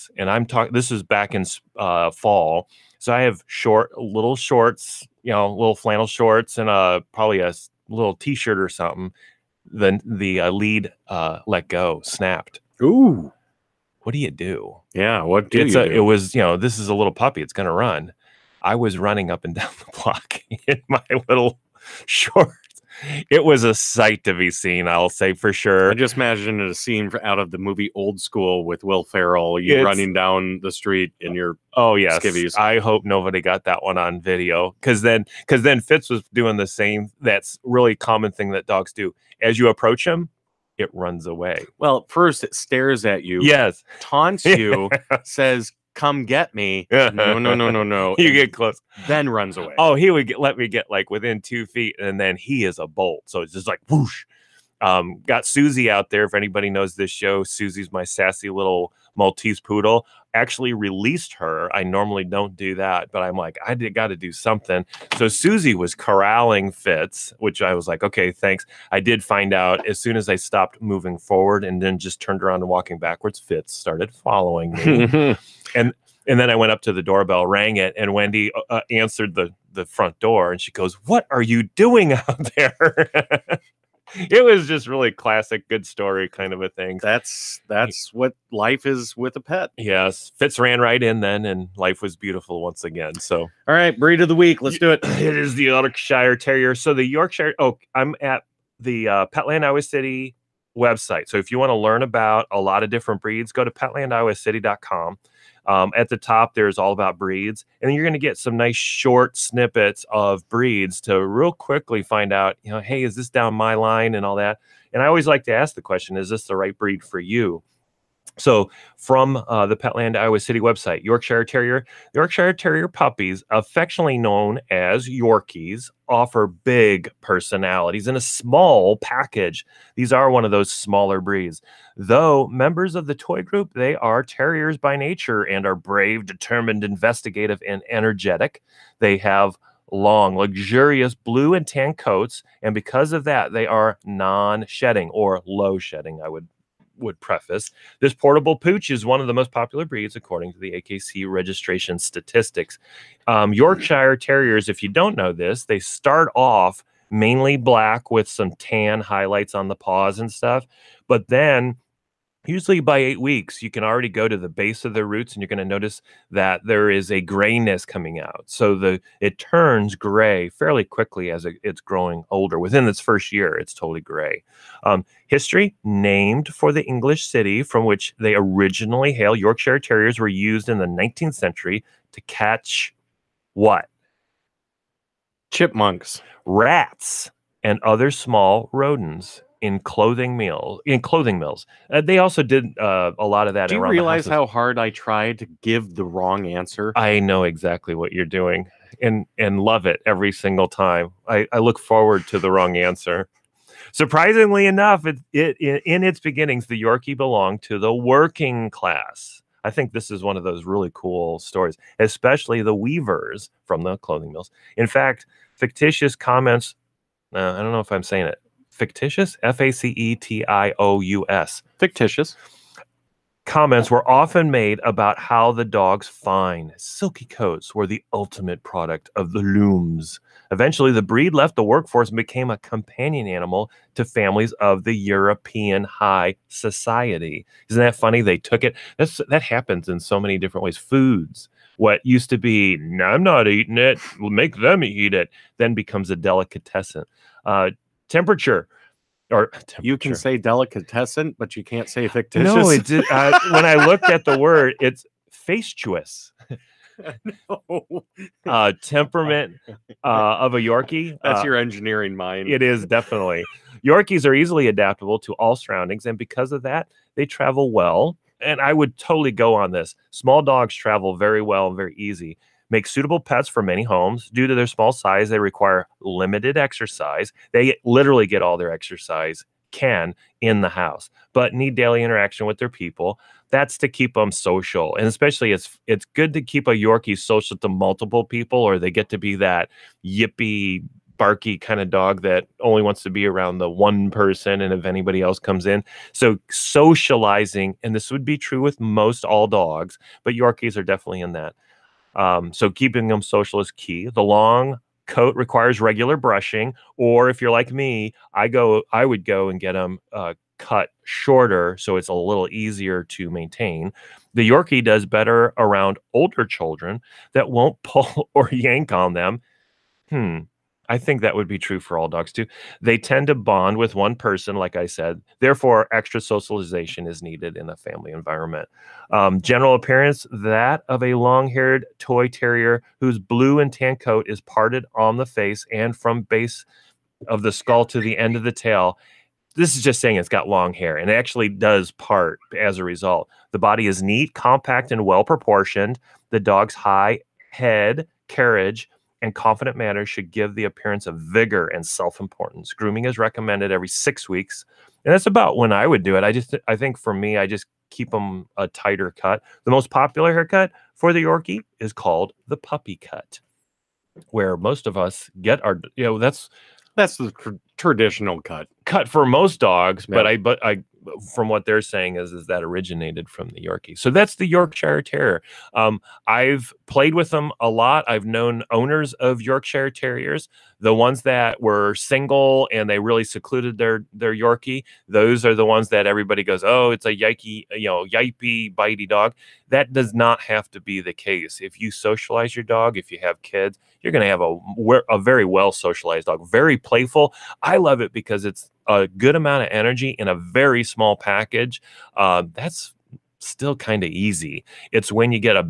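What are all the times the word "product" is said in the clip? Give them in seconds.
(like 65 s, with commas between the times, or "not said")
228 s.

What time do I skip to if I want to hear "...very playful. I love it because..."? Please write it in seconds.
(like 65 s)
396 s.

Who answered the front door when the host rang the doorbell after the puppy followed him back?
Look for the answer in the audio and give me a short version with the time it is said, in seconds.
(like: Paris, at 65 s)
Wendy, at 78 s.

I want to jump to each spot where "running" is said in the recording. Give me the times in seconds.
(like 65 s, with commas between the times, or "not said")
18 s, 29 s.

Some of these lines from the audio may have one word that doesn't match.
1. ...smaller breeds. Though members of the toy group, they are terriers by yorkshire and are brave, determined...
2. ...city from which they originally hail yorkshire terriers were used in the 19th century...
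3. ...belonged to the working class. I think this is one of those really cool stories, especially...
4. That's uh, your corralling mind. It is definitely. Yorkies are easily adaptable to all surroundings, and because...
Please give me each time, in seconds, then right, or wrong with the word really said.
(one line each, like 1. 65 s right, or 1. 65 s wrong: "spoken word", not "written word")
1. 130 s wrong: "nature", not "yorkshire"
2. 177 s right
3. 207 s right
4. 261 s wrong: "engineering", not "corralling".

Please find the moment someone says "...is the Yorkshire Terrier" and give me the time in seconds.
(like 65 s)
95 s.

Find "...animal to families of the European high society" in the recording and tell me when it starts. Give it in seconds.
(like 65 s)
233 s.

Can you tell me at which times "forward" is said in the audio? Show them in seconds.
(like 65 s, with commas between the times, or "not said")
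71 s, 201 s.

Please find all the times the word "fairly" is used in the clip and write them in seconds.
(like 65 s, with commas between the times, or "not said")
170 s.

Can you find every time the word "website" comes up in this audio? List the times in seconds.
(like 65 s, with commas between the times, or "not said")
100 s, 120 s.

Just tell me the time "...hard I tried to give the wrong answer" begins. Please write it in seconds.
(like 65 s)
194 s.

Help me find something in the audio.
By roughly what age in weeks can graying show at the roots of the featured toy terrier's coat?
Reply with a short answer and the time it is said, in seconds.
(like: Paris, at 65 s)
8 weeks, at 162 s.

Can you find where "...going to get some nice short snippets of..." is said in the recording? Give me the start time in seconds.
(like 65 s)
108 s.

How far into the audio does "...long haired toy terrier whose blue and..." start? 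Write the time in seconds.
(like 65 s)
331 s.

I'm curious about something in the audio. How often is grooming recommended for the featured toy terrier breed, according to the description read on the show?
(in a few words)
Every 6 weeks.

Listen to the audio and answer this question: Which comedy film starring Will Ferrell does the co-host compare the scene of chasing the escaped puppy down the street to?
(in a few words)
Old School.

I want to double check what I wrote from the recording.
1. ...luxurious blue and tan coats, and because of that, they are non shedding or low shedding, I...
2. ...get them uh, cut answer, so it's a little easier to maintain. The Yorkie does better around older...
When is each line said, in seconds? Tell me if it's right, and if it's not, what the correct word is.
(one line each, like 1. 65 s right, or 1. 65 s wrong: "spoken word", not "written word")
1. 140 s right
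2. 309 s wrong: "shorter", not "answer".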